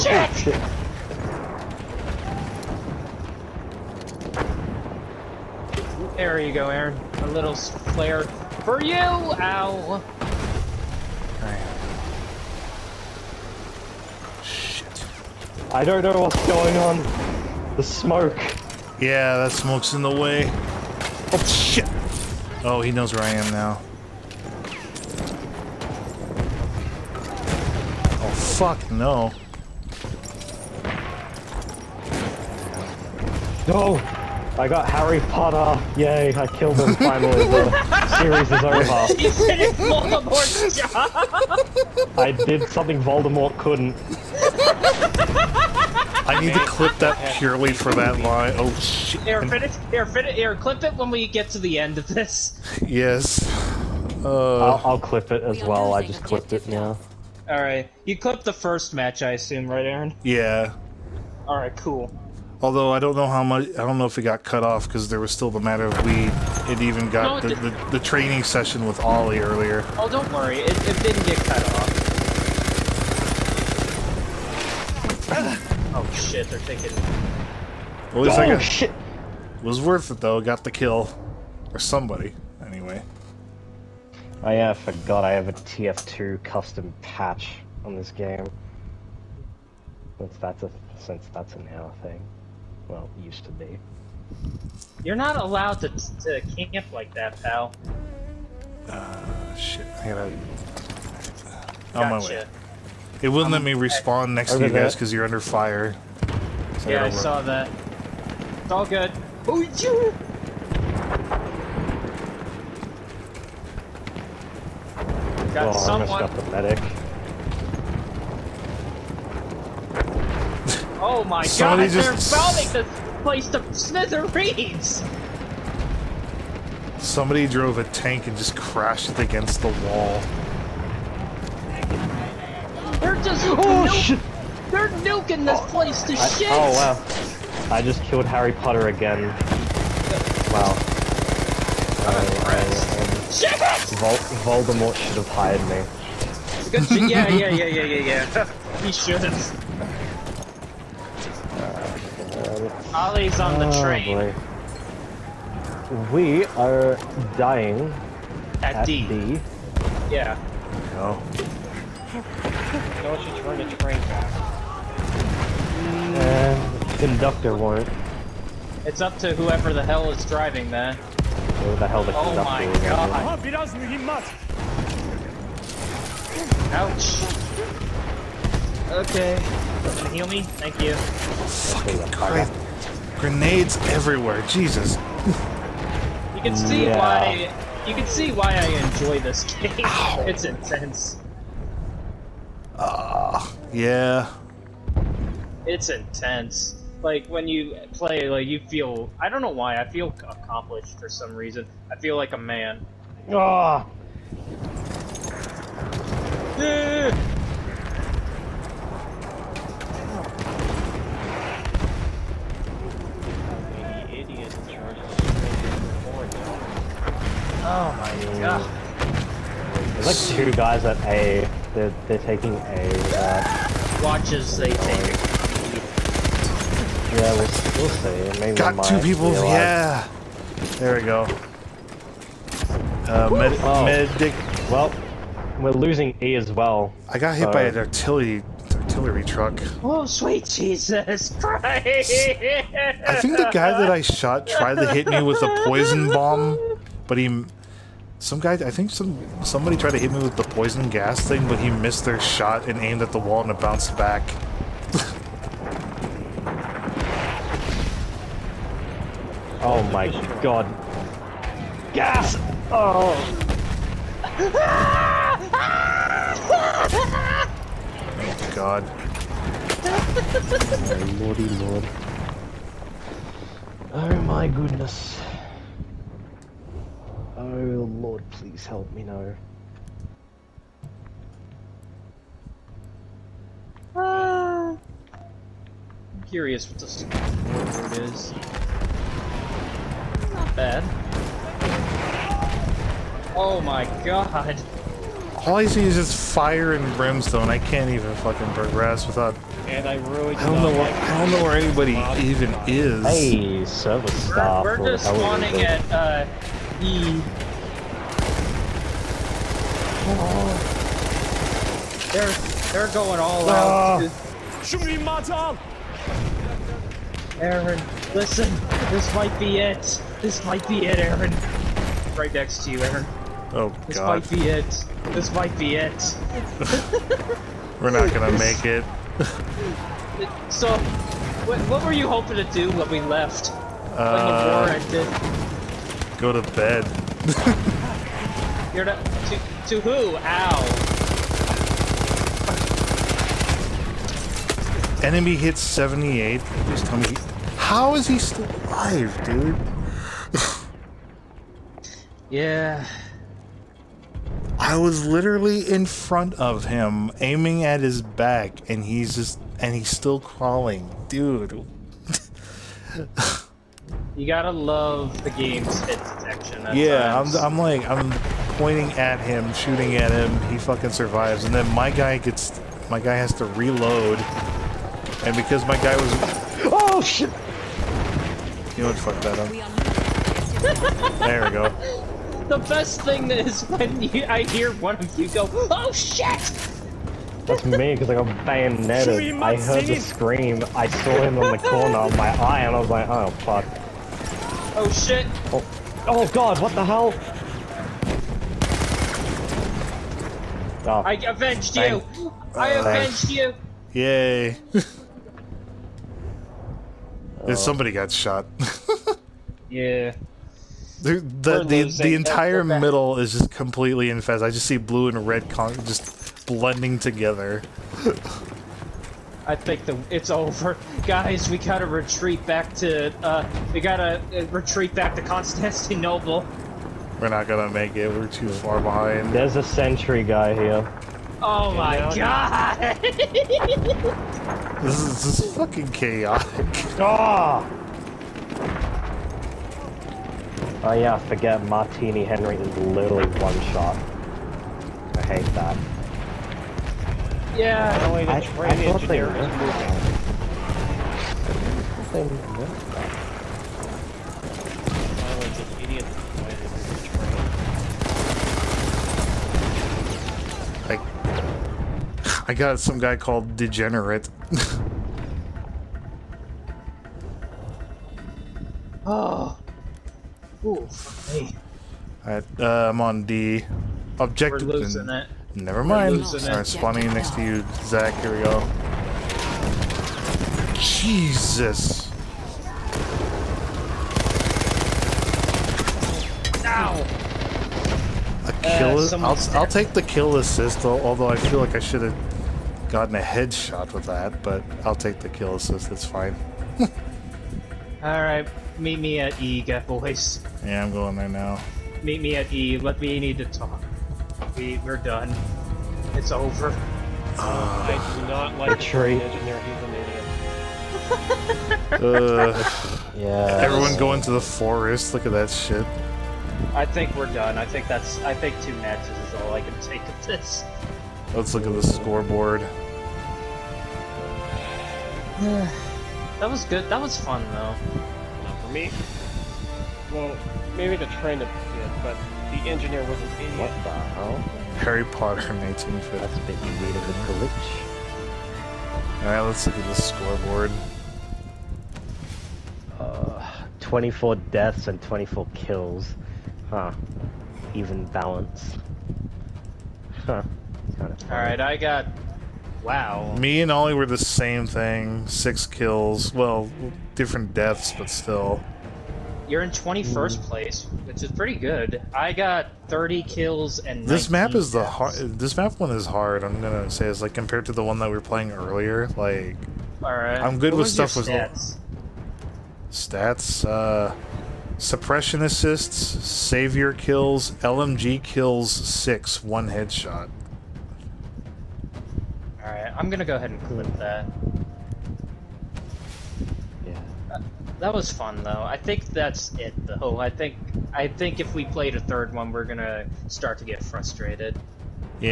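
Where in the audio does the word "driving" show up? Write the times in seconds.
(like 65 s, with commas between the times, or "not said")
170 s.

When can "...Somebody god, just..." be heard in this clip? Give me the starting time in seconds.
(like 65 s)
121 s.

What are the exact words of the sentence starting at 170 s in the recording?
Where the hell the oh conductor my is.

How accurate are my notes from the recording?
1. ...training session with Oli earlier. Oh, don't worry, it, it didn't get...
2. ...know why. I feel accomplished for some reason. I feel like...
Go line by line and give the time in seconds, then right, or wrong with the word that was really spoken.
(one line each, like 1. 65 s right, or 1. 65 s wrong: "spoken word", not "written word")
1. 67 s right
2. 199 s right.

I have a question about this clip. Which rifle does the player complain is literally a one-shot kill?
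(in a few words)
Martini Henry.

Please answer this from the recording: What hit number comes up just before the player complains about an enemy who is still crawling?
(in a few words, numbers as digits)
78.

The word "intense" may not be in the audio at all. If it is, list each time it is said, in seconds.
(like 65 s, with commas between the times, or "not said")
190 s, 195 s.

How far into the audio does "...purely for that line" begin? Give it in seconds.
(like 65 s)
47 s.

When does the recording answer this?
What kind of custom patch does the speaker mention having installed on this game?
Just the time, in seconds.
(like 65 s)
85 s.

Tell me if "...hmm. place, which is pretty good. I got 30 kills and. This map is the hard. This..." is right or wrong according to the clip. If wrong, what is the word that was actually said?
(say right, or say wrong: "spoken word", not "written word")
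right.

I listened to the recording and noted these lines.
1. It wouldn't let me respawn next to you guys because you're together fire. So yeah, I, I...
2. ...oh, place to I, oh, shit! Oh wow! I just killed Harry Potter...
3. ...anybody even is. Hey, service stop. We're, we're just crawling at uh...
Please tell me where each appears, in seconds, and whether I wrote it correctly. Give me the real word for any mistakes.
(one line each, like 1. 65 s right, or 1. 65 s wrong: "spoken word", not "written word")
1. 103 s wrong: "under", not "together"
2. 135 s right
3. 301 s wrong: "spawning", not "crawling".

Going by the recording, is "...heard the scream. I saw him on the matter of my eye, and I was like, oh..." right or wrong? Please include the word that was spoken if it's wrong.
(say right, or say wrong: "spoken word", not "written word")
wrong: "corner", not "matter".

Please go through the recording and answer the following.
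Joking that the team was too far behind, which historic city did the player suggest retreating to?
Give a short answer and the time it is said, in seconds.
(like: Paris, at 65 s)
Constantinople, at 425 s.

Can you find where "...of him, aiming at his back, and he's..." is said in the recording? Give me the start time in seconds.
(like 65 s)
356 s.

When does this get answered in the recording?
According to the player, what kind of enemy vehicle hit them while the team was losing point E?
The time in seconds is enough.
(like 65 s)
238 s.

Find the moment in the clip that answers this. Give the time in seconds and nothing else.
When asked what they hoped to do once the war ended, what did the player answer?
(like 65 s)
336 s.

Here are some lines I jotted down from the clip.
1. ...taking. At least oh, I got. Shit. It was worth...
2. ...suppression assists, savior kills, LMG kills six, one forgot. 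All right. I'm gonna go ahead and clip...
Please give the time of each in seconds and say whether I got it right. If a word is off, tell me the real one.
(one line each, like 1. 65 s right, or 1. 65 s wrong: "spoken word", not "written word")
1. 76 s right
2. 574 s wrong: "headshot", not "forgot".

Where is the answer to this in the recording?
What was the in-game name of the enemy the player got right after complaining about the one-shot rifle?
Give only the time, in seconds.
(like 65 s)
463 s.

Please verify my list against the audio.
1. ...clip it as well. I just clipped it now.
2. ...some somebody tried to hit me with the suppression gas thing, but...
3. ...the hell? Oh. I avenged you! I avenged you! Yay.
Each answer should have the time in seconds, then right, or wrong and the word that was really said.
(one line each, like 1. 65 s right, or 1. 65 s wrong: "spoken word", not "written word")
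1. 54 s right
2. 248 s wrong: "poison", not "suppression"
3. 396 s right.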